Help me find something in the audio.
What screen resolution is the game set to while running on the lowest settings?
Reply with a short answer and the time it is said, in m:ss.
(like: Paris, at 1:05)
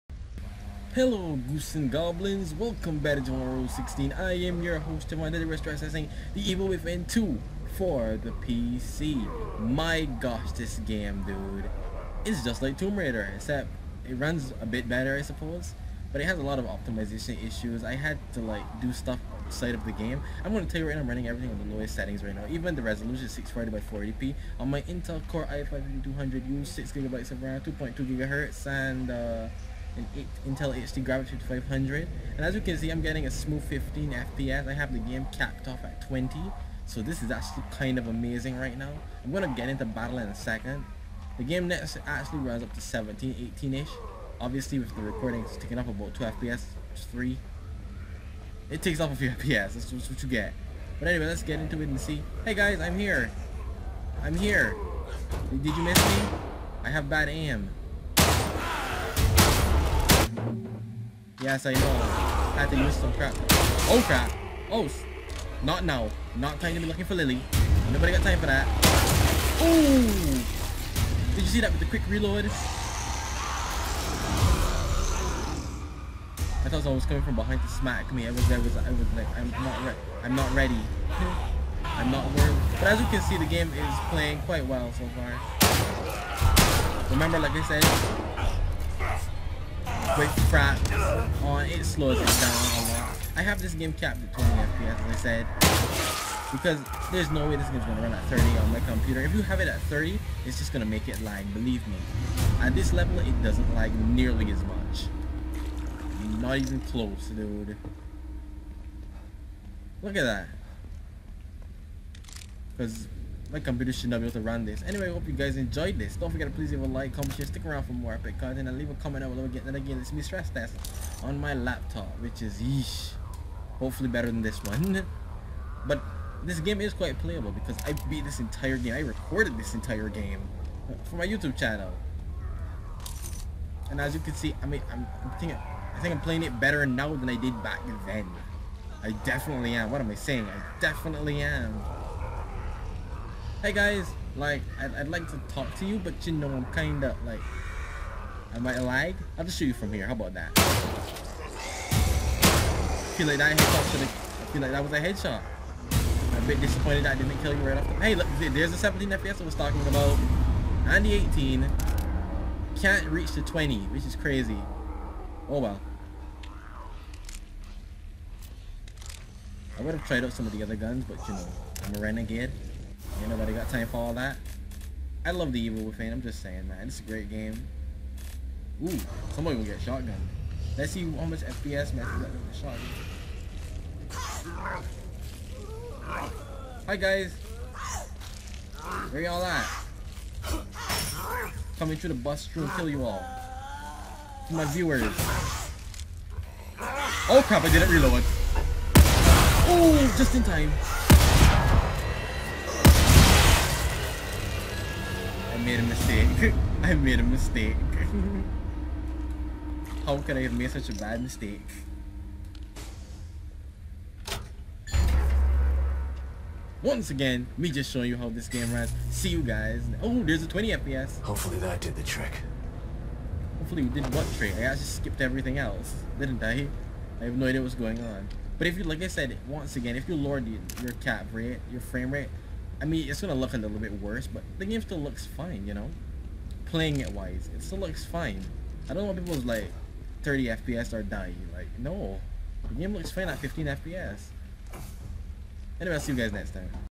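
640 by 480, at 0:23.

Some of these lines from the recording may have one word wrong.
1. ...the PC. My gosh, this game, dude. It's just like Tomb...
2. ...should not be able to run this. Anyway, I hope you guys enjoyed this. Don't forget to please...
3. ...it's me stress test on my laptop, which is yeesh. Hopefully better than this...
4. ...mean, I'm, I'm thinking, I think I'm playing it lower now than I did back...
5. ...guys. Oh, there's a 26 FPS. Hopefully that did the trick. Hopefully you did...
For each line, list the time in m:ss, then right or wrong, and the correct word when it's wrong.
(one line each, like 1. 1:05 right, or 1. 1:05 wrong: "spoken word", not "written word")
1. 0:08 right
2. 1:53 right
3. 1:59 right
4. 2:14 wrong: "better", not "lower"
5. 3:39 wrong: "20", not "26".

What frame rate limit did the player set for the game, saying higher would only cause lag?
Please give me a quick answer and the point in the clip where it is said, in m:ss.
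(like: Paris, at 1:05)
20 FPS, at 0:35.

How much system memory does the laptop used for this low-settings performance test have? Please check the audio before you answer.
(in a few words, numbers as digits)
6GB.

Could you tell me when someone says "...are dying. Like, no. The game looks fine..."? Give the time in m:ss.
4:00.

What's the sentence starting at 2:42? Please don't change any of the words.
Can't reach the 20, which is crazy.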